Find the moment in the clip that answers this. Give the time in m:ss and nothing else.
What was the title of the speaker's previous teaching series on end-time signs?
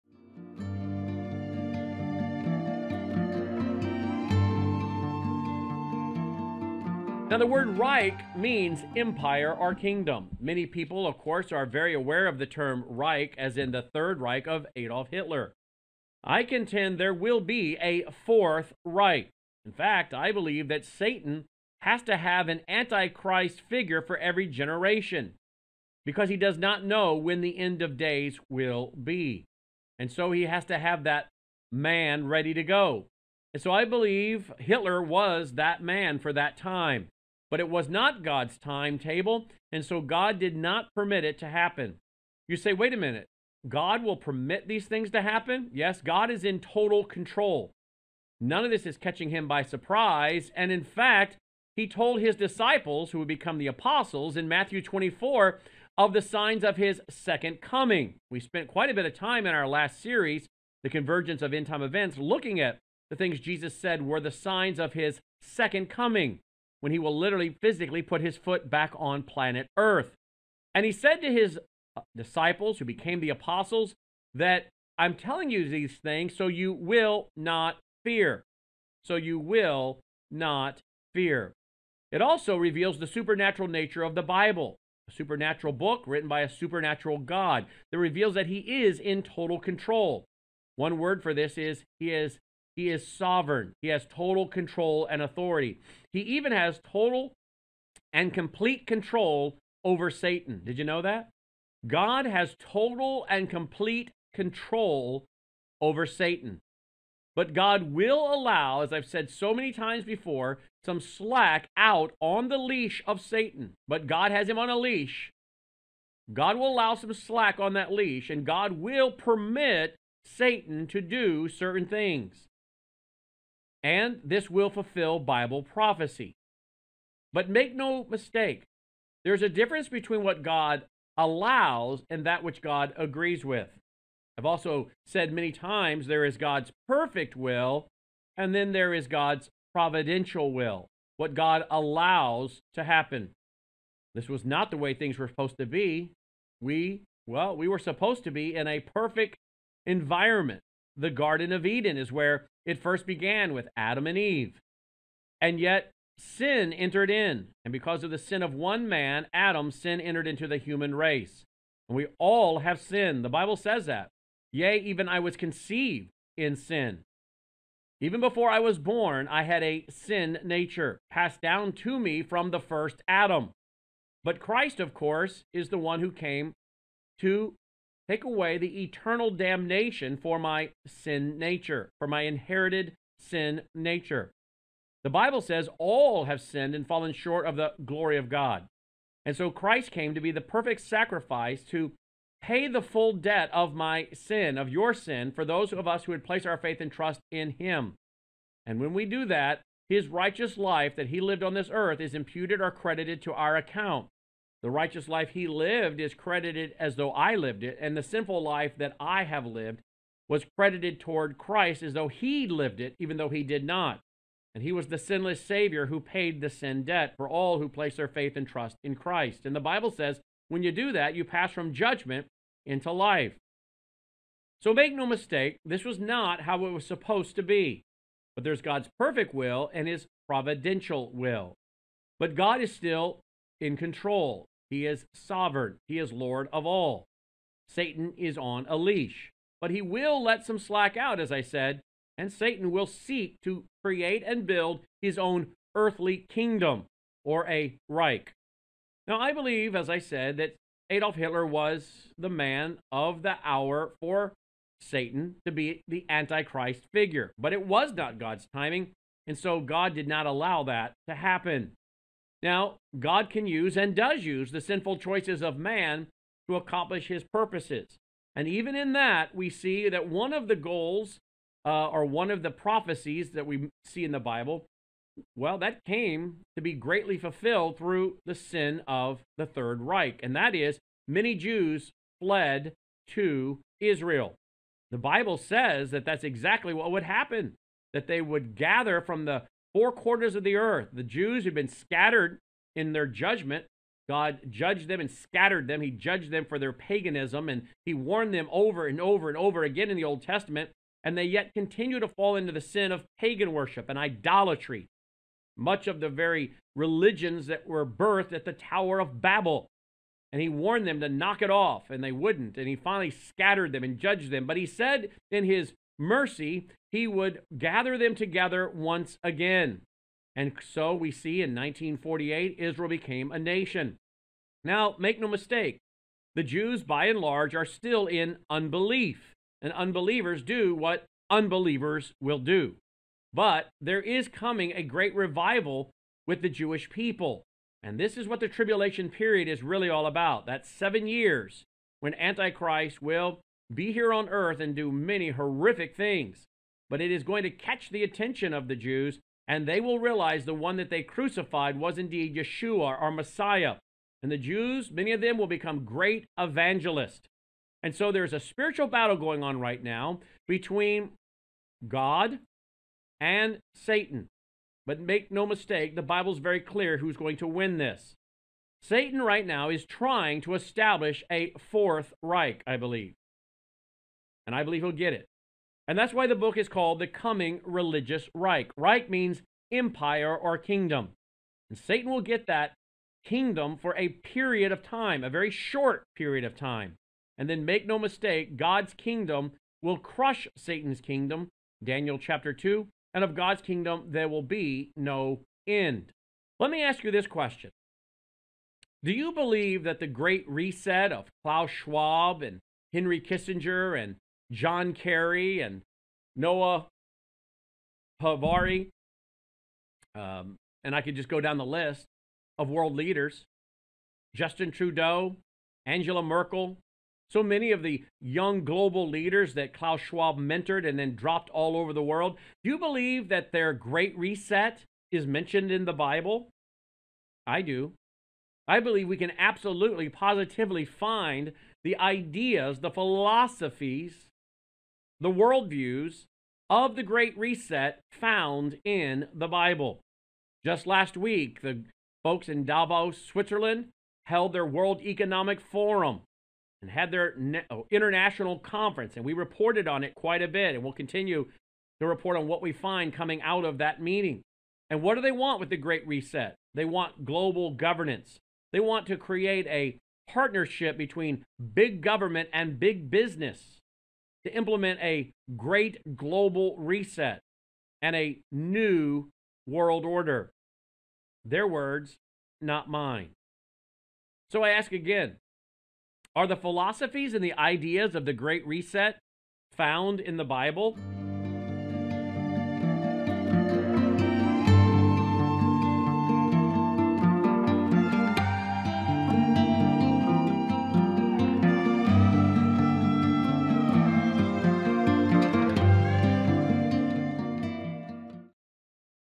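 1:00.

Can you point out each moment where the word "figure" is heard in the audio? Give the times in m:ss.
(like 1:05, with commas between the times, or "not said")
0:23, 4:16.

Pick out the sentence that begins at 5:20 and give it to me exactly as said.
And so we see in 1948, Israel became a nation.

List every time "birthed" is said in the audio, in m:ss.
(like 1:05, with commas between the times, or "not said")
5:07.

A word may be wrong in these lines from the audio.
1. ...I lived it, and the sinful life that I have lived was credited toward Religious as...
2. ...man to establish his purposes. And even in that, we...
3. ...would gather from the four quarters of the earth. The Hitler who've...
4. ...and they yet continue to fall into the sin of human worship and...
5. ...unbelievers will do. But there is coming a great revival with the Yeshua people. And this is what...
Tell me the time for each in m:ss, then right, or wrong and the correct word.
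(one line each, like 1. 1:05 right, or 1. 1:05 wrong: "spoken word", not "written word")
1. 3:27 wrong: "Christ", not "Religious"
2. 4:25 wrong: "accomplish", not "establish"
3. 4:48 wrong: "Jews", not "Hitler"
4. 5:01 wrong: "pagan", not "human"
5. 5:31 wrong: "Jewish", not "Yeshua".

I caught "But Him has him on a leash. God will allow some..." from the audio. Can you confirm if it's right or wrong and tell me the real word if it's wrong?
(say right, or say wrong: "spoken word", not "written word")
wrong: "God", not "Him".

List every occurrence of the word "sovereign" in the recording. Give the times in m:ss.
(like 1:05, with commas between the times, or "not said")
1:33, 3:55.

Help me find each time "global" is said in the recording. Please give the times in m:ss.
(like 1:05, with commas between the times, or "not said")
6:58, 7:37, 7:46.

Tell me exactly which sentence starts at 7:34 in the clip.
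And what do they want with the Great Reset?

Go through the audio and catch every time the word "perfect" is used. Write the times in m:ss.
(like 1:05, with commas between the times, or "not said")
2:16, 2:28, 3:10, 3:48.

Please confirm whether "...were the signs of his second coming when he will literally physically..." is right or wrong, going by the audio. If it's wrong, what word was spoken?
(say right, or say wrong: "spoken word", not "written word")
right.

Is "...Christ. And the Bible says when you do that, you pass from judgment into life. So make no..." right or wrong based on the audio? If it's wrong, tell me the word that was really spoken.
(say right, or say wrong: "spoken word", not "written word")
right.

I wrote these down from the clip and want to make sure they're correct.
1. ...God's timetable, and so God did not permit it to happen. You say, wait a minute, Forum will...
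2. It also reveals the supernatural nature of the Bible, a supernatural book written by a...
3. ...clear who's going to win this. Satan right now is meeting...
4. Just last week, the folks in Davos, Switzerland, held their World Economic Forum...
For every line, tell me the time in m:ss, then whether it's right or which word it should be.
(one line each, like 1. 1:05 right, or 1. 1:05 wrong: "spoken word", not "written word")
1. 0:38 wrong: "God", not "Forum"
2. 1:22 right
3. 6:06 wrong: "trying", not "meeting"
4. 7:20 right.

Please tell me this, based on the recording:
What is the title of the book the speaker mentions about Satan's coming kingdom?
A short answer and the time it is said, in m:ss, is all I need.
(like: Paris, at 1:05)
The Coming Religious Reich, at 6:16.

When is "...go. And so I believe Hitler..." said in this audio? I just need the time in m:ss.
0:32.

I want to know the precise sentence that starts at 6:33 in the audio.
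And of God's kingdom, there will be no end.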